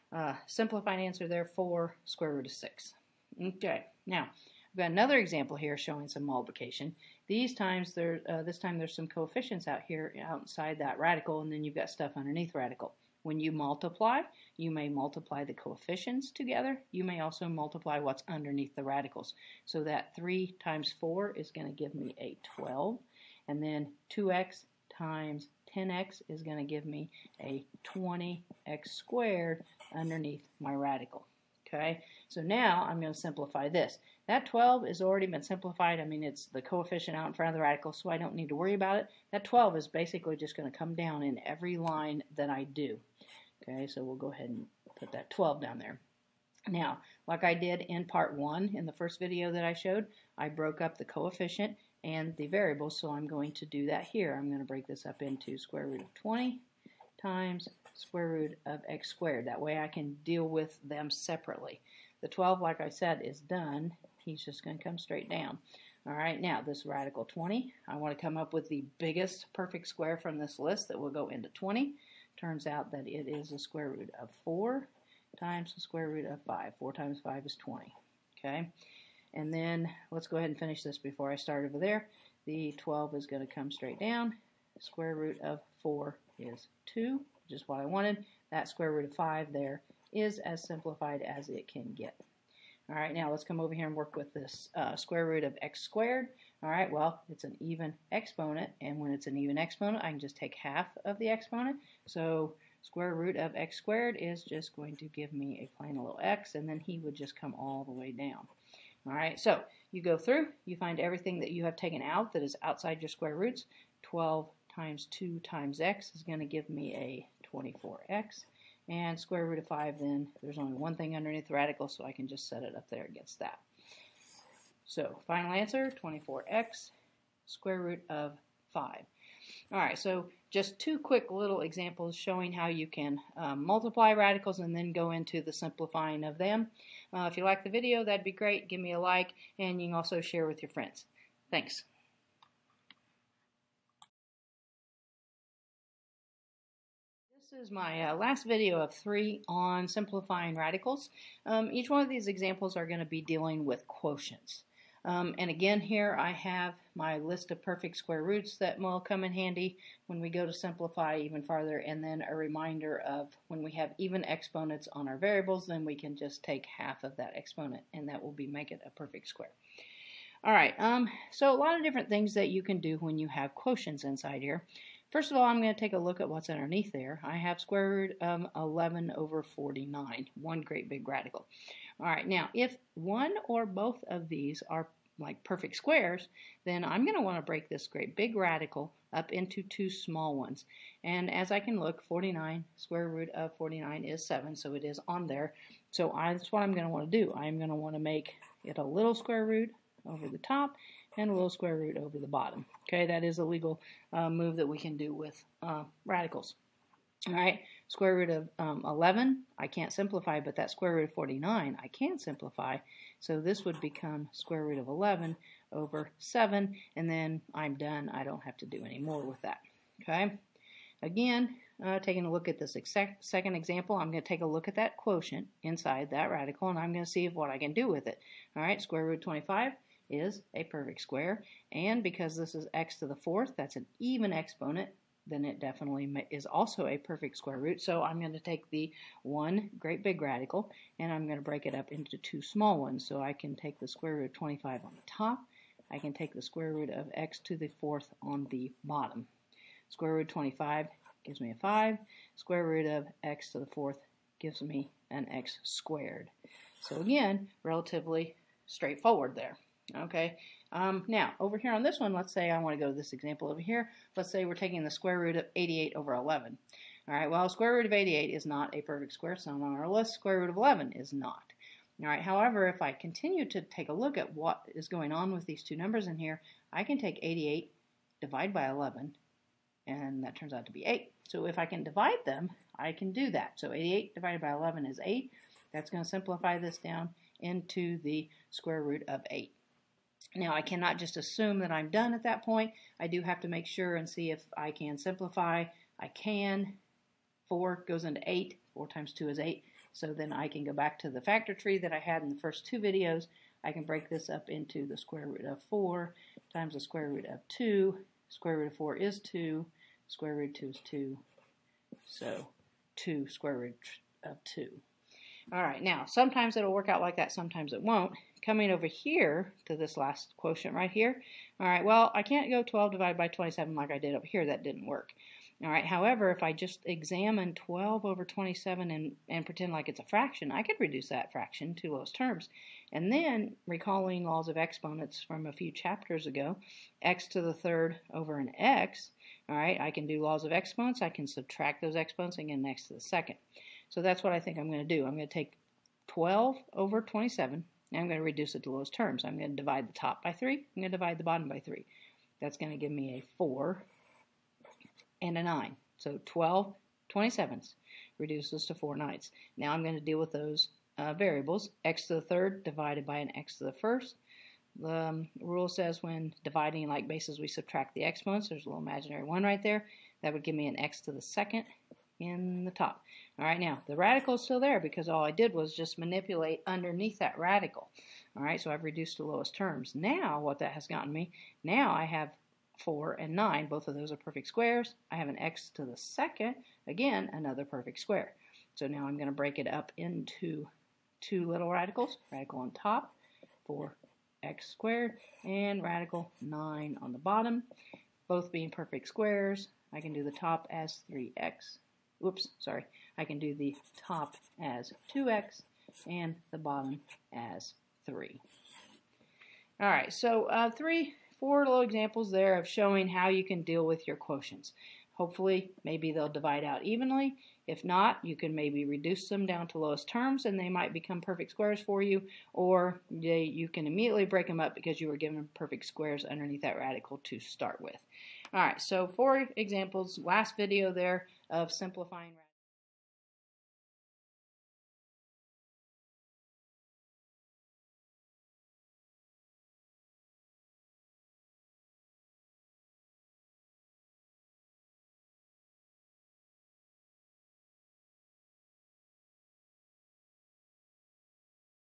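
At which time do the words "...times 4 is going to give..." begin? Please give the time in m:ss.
0:20.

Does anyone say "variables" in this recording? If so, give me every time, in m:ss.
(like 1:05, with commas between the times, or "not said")
0:52, 2:45, 6:01.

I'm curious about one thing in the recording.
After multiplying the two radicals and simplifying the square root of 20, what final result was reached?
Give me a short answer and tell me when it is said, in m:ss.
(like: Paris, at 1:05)
24x square root of 5, at 2:06.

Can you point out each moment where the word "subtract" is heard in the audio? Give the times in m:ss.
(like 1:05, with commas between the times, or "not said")
5:41, 6:07.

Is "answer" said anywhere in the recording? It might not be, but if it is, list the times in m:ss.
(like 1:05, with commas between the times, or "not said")
0:00, 2:05.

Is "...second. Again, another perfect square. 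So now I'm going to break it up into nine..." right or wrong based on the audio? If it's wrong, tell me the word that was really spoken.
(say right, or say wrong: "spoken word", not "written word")
wrong: "two", not "nine".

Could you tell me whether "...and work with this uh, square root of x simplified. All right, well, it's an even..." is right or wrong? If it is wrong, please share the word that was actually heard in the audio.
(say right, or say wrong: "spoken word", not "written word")
wrong: "squared", not "simplified".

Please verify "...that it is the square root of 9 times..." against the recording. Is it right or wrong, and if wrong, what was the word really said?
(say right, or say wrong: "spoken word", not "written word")
wrong: "4", not "9".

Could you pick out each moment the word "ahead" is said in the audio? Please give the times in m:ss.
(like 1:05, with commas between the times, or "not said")
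0:44, 1:20.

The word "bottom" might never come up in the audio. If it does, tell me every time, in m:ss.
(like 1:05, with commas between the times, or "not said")
3:22, 4:08, 5:51, 6:37, 6:46.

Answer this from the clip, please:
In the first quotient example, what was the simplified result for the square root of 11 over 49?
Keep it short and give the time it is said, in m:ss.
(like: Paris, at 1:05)
square root of 11 over 7, at 3:34.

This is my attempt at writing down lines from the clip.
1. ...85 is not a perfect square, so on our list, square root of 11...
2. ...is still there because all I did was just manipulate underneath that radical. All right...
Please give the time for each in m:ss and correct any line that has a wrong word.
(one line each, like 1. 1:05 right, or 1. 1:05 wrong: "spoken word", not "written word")
1. 4:27 wrong: "88", not "85"
2. 6:14 right.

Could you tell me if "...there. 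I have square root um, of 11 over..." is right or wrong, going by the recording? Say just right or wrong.
right.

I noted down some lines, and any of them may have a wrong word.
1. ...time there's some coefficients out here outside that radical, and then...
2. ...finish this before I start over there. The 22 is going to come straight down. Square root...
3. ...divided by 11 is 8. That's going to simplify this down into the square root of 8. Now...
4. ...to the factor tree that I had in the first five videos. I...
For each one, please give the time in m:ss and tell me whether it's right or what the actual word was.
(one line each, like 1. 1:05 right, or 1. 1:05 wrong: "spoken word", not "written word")
1. 0:08 right
2. 1:20 wrong: "12", not "22"
3. 4:44 right
4. 5:00 wrong: "two", not "five".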